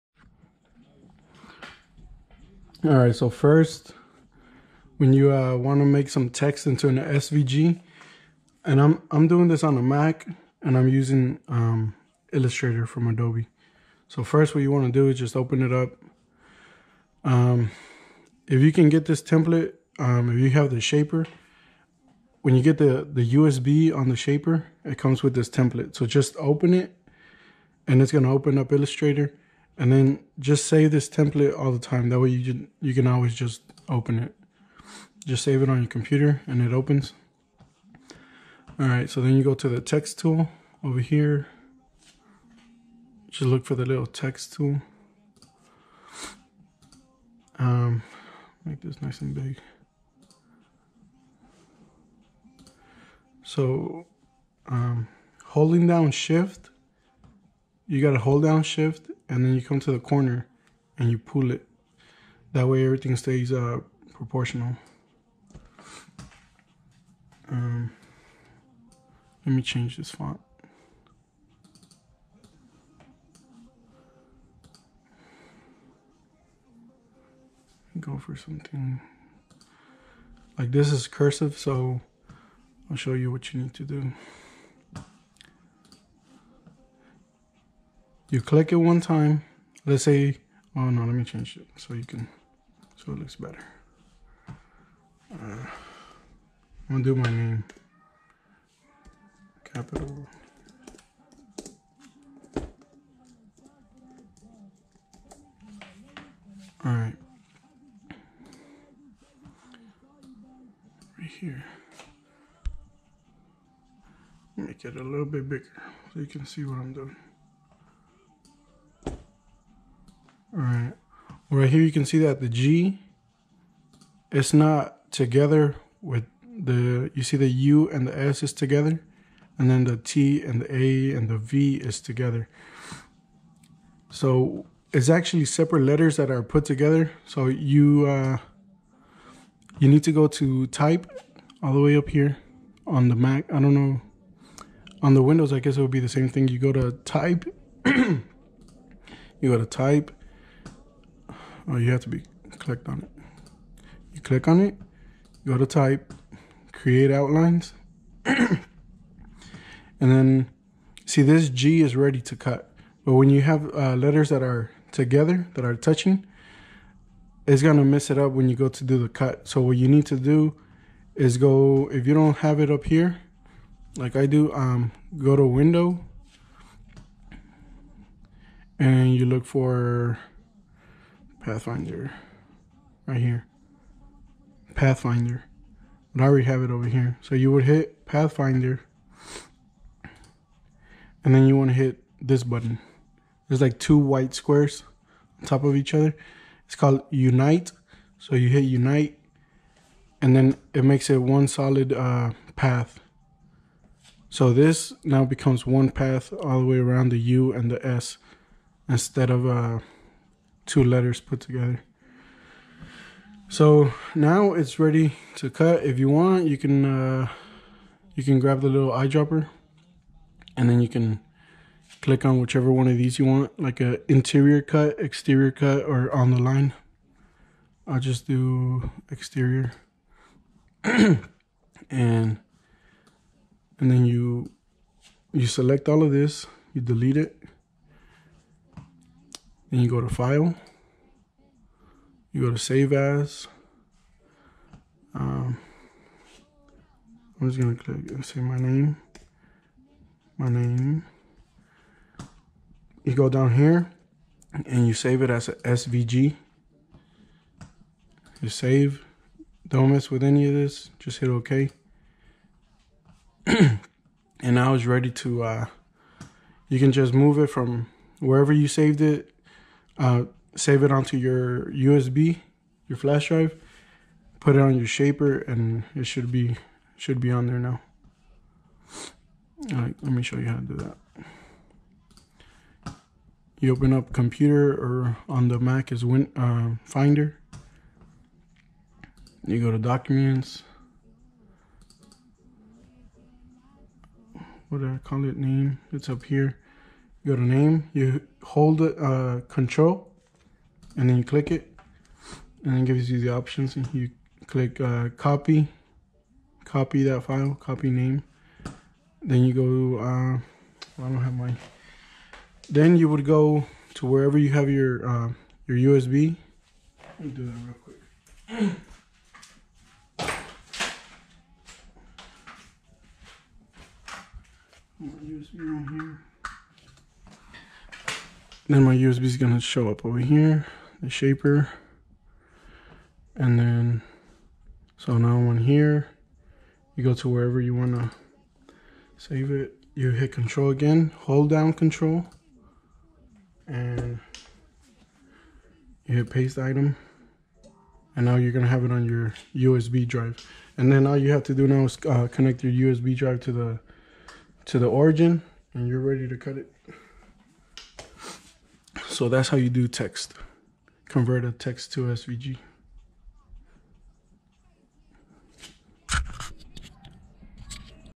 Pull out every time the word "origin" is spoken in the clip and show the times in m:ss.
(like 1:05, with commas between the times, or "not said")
5:54.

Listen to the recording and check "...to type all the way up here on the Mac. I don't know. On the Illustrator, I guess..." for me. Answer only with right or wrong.
wrong.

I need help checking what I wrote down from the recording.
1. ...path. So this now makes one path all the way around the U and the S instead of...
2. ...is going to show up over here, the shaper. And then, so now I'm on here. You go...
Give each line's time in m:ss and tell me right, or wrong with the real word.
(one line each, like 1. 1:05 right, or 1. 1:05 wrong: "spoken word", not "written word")
1. 3:22 wrong: "becomes", not "makes"
2. 5:29 right.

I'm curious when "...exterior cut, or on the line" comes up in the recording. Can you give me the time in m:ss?
3:44.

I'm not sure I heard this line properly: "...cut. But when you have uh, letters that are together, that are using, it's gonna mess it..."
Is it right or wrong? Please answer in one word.
wrong.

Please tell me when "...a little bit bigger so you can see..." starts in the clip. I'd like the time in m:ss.
1:54.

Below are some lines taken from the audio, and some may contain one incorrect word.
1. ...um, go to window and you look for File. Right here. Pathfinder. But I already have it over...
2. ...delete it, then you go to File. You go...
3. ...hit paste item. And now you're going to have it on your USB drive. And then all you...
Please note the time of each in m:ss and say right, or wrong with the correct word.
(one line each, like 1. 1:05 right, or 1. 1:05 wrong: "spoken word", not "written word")
1. 2:54 wrong: "Pathfinder", not "File"
2. 3:56 right
3. 5:46 right.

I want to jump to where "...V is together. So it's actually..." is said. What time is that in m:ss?
2:11.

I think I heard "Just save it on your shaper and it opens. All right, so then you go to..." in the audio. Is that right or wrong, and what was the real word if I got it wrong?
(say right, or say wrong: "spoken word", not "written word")
wrong: "computer", not "shaper".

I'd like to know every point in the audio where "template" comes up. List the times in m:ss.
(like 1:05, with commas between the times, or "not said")
0:19, 0:25, 0:31.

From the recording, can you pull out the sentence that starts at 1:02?
That way everything stays uh, proportional.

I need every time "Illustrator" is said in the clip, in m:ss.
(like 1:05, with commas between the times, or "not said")
0:12, 0:28.